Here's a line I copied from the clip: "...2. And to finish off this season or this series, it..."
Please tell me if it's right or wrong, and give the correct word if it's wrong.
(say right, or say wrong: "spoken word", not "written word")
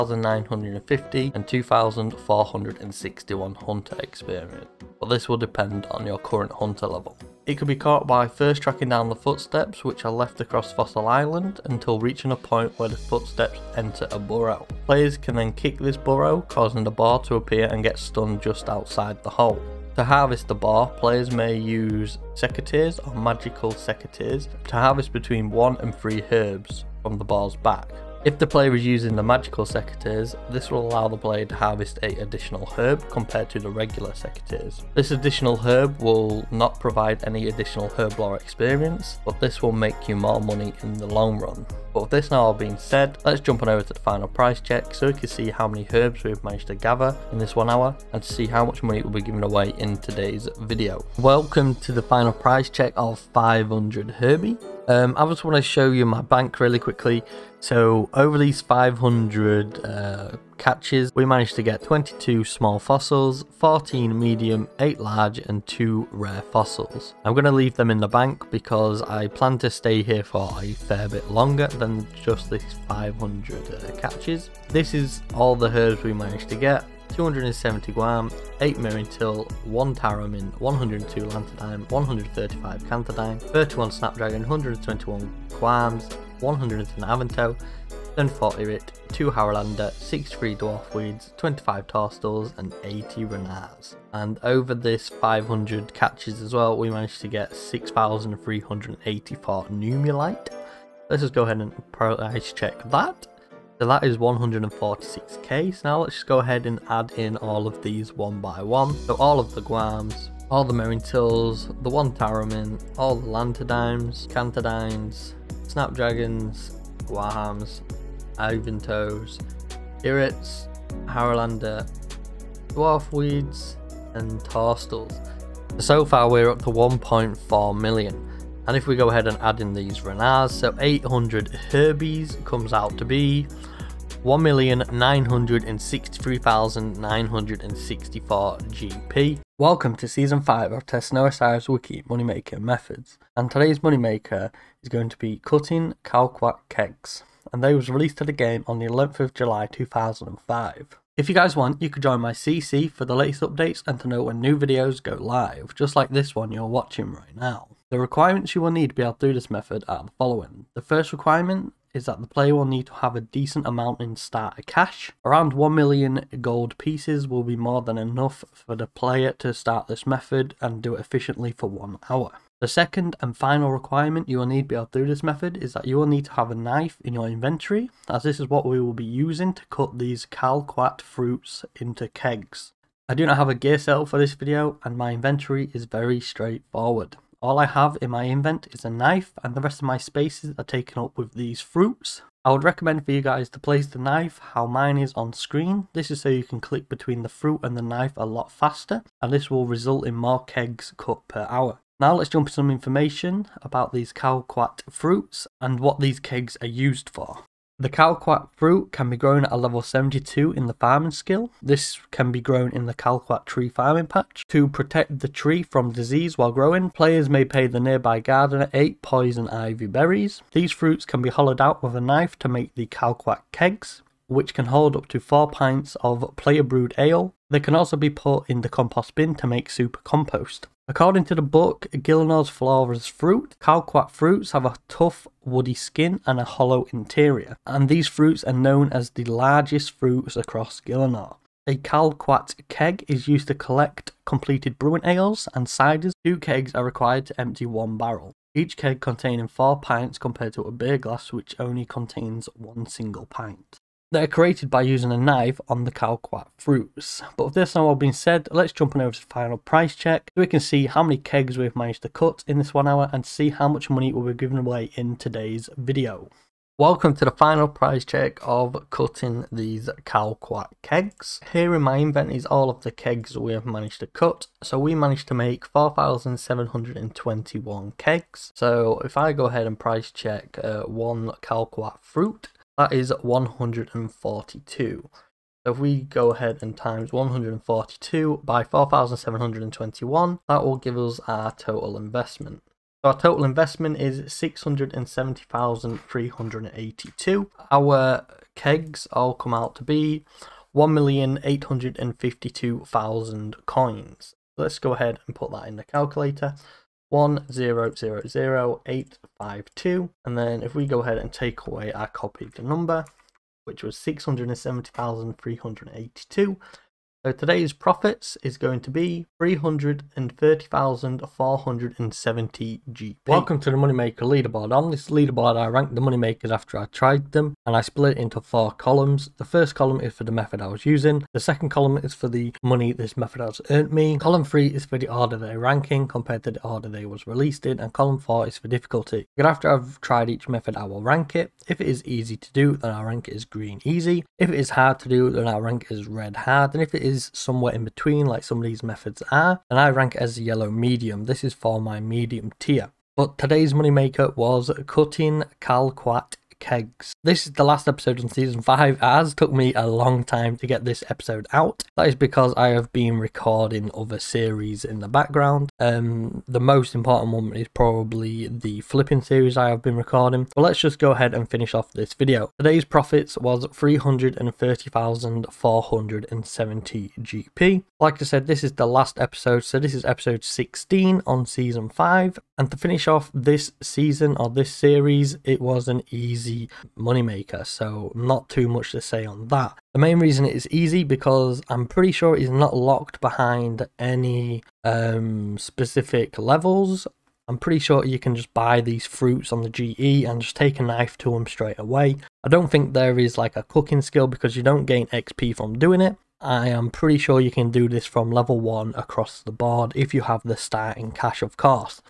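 wrong: "5", not "2".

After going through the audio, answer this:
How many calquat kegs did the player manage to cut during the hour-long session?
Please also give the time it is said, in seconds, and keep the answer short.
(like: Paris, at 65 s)
4,721, at 275 s.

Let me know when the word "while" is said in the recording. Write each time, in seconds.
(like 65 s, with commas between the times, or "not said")
216 s.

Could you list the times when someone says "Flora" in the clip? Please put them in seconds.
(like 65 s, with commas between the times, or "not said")
232 s.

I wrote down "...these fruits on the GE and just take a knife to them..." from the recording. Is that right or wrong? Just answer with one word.
right.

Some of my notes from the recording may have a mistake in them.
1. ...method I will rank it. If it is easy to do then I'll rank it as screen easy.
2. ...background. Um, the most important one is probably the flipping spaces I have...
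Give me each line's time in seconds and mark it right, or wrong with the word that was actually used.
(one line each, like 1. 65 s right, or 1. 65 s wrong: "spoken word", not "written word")
1. 340 s wrong: "green", not "screen"
2. 365 s wrong: "series", not "spaces".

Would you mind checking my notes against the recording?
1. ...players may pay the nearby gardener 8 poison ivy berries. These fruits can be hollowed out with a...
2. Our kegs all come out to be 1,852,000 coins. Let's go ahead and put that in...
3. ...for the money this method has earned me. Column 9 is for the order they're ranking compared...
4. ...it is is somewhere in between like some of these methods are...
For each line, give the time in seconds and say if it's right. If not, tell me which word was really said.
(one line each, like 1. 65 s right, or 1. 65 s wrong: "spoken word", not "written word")
1. 216 s right
2. 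297 s right
3. 332 s wrong: "3", not "9"
4. 346 s right.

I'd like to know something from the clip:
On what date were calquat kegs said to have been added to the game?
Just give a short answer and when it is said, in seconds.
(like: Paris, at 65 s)
11 July 2005, at 148 s.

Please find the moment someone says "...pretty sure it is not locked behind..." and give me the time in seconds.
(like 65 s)
391 s.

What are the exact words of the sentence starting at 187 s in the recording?
All I have in my invent is a knife and the rest of my spaces are taken up with these fruits.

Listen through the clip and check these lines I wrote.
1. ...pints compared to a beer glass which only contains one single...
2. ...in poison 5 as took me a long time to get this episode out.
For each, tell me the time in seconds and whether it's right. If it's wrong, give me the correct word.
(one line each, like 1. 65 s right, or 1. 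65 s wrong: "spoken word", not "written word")
1. 249 s right
2. 358 s wrong: "season", not "poison".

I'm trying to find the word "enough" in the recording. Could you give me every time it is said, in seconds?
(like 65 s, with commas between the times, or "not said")
167 s.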